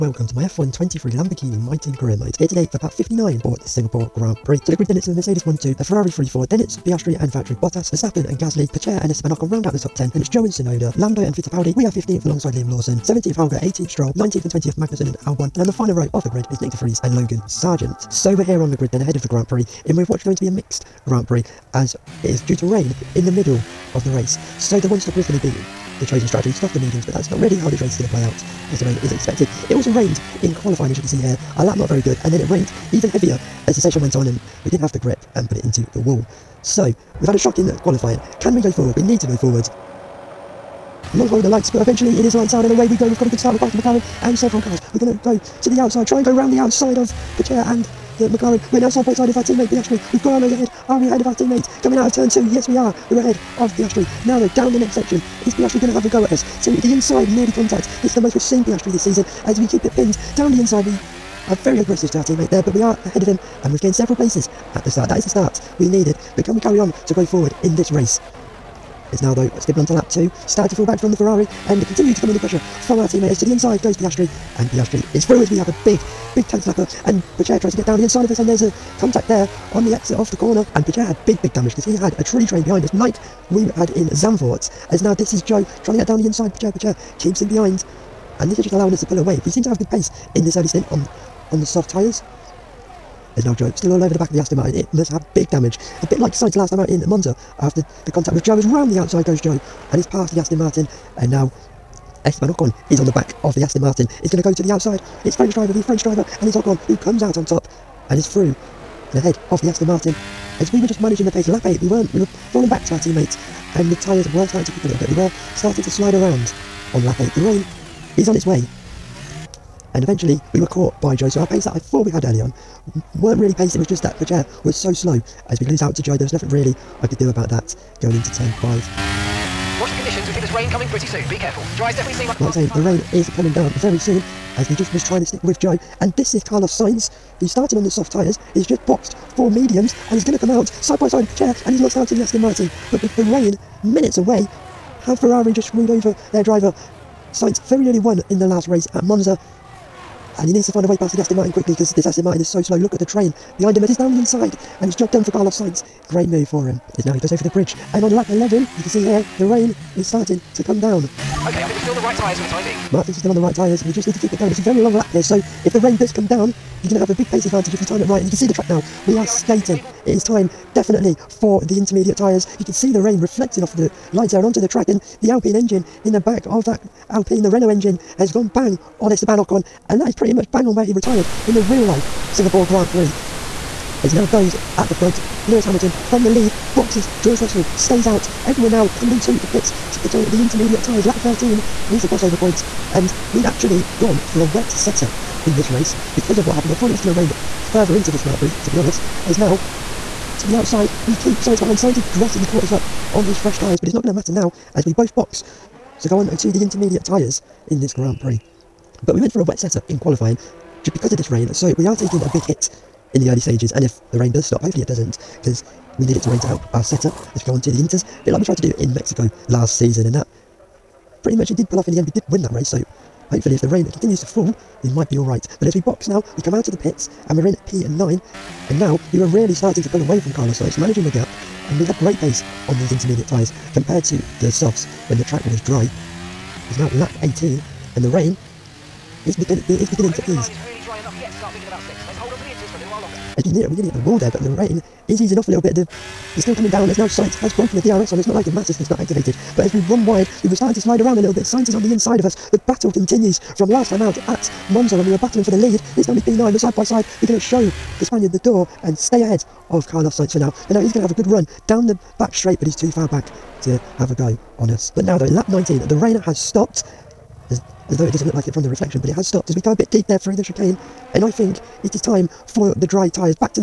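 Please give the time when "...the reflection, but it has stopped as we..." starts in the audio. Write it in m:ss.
4:28.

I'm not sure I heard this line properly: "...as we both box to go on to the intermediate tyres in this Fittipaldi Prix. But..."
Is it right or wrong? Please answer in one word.
wrong.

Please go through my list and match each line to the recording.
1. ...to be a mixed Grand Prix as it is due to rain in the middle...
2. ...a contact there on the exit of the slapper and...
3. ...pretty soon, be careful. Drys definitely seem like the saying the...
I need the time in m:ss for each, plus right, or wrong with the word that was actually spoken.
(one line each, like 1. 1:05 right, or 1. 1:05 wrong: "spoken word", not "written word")
1. 0:20 right
2. 1:18 wrong: "corner", not "slapper"
3. 2:10 right.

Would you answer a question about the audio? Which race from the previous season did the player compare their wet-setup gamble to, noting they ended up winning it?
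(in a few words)
Mexico.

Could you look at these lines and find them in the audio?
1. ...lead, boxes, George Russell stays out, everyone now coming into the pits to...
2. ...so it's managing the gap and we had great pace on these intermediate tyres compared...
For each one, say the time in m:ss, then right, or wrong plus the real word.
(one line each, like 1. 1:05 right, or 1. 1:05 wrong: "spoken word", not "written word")
1. 3:06 right
2. 3:50 right.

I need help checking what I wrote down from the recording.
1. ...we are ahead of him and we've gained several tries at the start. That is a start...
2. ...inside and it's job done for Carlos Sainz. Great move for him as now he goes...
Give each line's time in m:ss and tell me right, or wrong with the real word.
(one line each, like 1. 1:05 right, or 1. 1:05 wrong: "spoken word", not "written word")
1. 1:02 wrong: "places", not "tries"
2. 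2:34 right.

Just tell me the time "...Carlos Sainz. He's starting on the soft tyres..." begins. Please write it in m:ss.
2:16.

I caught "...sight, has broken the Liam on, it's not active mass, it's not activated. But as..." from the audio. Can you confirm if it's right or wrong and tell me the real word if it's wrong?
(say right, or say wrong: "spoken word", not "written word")
wrong: "DRS", not "Liam".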